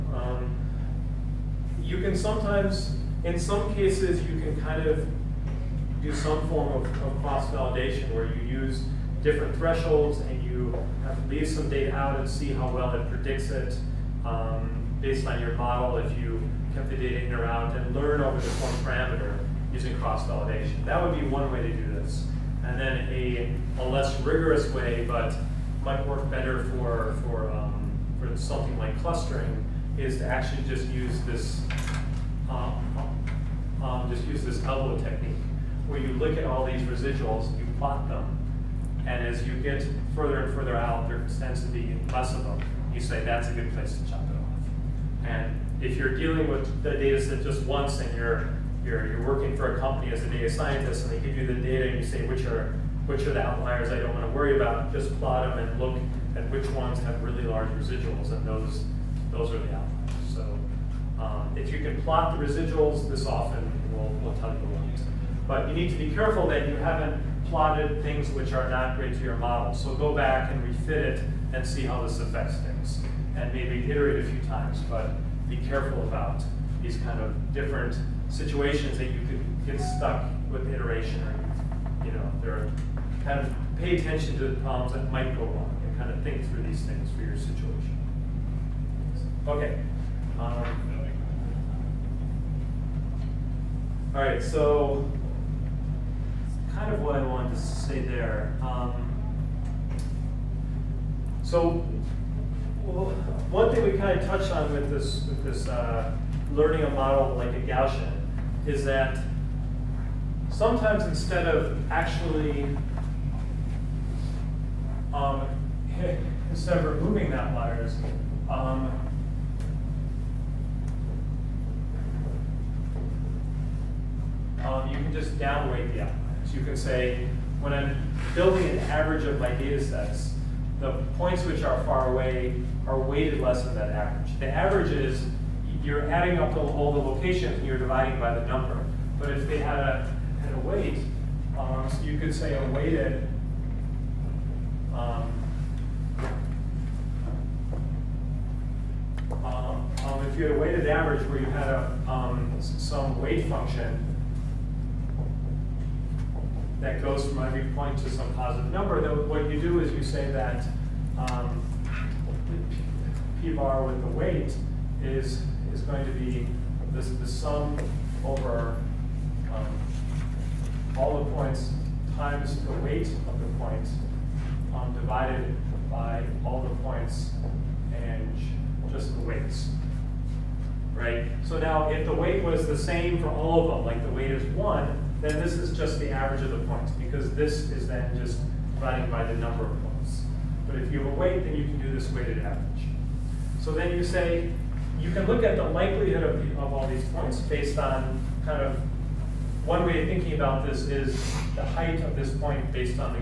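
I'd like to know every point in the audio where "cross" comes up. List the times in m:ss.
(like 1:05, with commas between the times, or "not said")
0:07, 0:19.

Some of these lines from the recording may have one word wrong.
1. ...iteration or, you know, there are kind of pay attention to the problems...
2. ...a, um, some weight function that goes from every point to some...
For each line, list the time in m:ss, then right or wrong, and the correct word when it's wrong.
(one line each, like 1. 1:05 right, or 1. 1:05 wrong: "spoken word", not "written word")
1. 1:20 right
2. 2:31 right.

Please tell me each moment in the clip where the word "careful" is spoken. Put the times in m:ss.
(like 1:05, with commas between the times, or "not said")
1:06, 1:15.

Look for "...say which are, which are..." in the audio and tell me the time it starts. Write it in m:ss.
0:52.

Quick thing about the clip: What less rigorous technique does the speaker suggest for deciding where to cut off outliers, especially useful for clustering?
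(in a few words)
elbow technique.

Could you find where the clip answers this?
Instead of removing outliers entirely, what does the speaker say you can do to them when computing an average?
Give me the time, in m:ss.
2:05.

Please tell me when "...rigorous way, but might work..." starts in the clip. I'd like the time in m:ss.
0:24.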